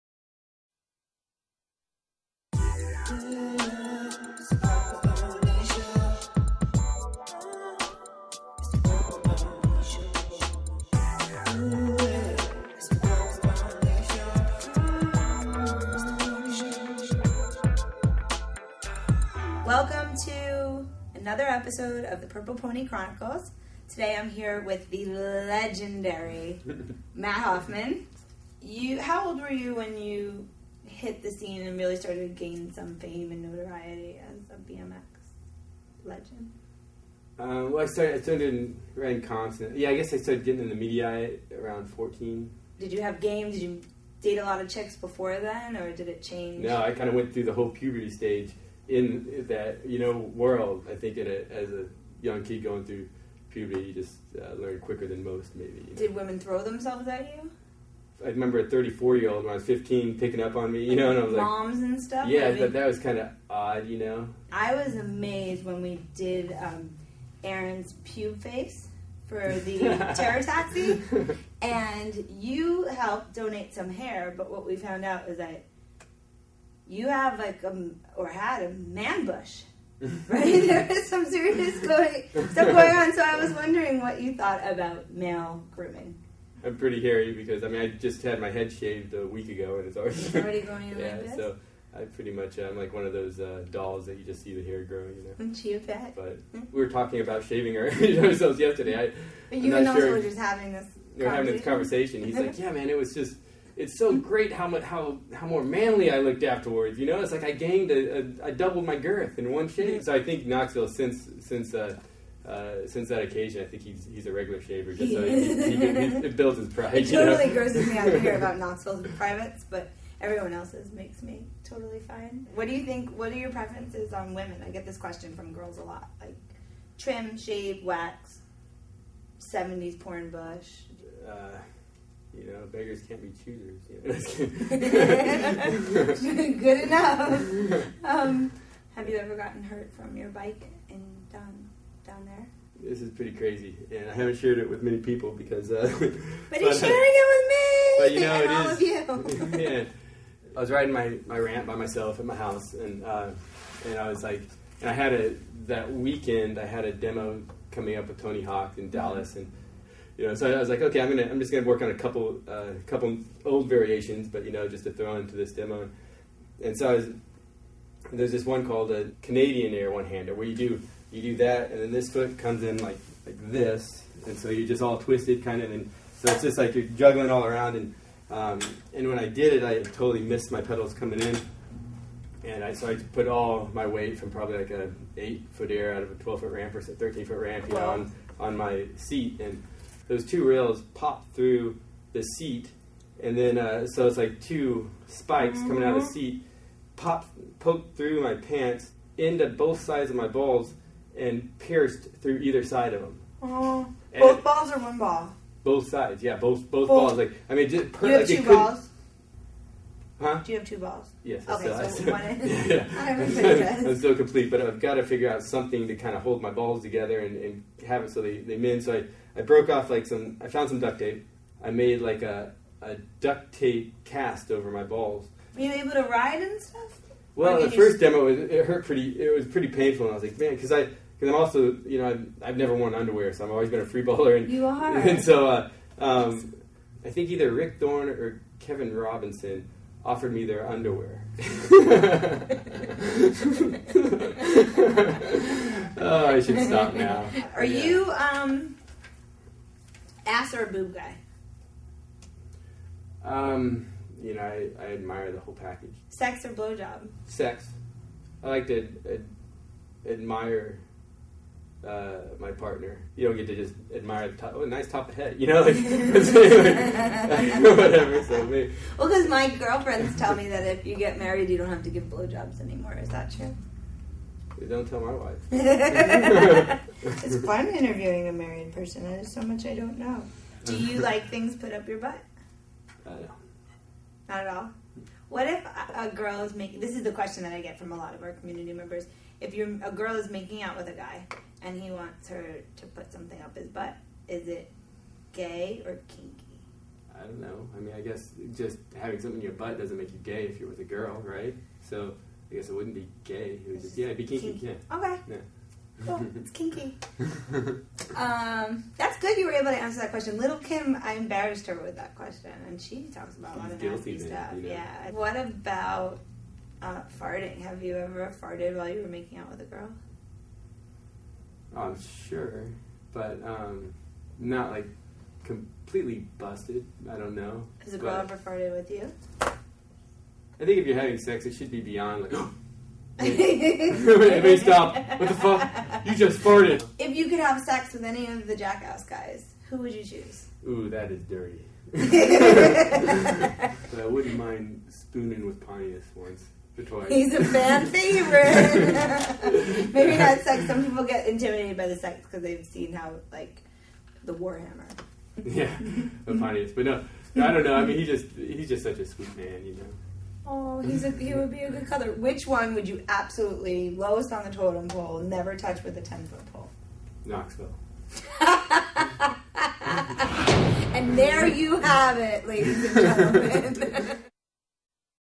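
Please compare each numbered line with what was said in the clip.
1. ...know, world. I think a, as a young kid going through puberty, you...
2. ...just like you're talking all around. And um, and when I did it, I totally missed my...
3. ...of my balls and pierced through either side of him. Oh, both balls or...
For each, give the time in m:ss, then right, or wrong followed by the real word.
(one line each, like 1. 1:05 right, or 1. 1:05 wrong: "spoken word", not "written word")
1. 0:49 right
2. 2:56 wrong: "juggling", not "talking"
3. 3:20 right.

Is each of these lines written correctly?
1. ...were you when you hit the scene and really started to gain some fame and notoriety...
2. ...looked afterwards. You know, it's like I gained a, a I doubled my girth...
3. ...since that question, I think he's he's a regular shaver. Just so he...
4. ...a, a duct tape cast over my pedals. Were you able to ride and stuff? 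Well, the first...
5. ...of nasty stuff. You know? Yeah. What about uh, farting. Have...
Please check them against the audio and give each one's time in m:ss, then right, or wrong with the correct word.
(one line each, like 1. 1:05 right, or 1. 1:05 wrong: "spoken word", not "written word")
1. 0:29 right
2. 1:46 right
3. 1:52 wrong: "occasion", not "question"
4. 3:42 wrong: "balls", not "pedals"
5. 5:13 right.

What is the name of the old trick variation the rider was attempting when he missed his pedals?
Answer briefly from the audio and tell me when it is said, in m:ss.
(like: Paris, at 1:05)
Canadian air one hander, at 2:49.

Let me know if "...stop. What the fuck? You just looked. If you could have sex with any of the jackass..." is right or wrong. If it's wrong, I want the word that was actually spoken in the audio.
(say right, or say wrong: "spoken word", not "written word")
wrong: "farted", not "looked".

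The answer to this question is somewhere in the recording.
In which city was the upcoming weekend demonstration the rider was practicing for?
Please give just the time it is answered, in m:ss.
2:38.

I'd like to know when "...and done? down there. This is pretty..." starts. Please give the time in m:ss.
2:20.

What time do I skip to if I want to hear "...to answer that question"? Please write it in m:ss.
5:09.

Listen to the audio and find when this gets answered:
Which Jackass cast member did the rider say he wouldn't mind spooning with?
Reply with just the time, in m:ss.
5:45.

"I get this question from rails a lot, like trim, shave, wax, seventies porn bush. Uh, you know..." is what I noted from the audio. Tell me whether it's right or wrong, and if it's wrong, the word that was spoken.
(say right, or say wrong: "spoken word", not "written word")
wrong: "girls", not "rails".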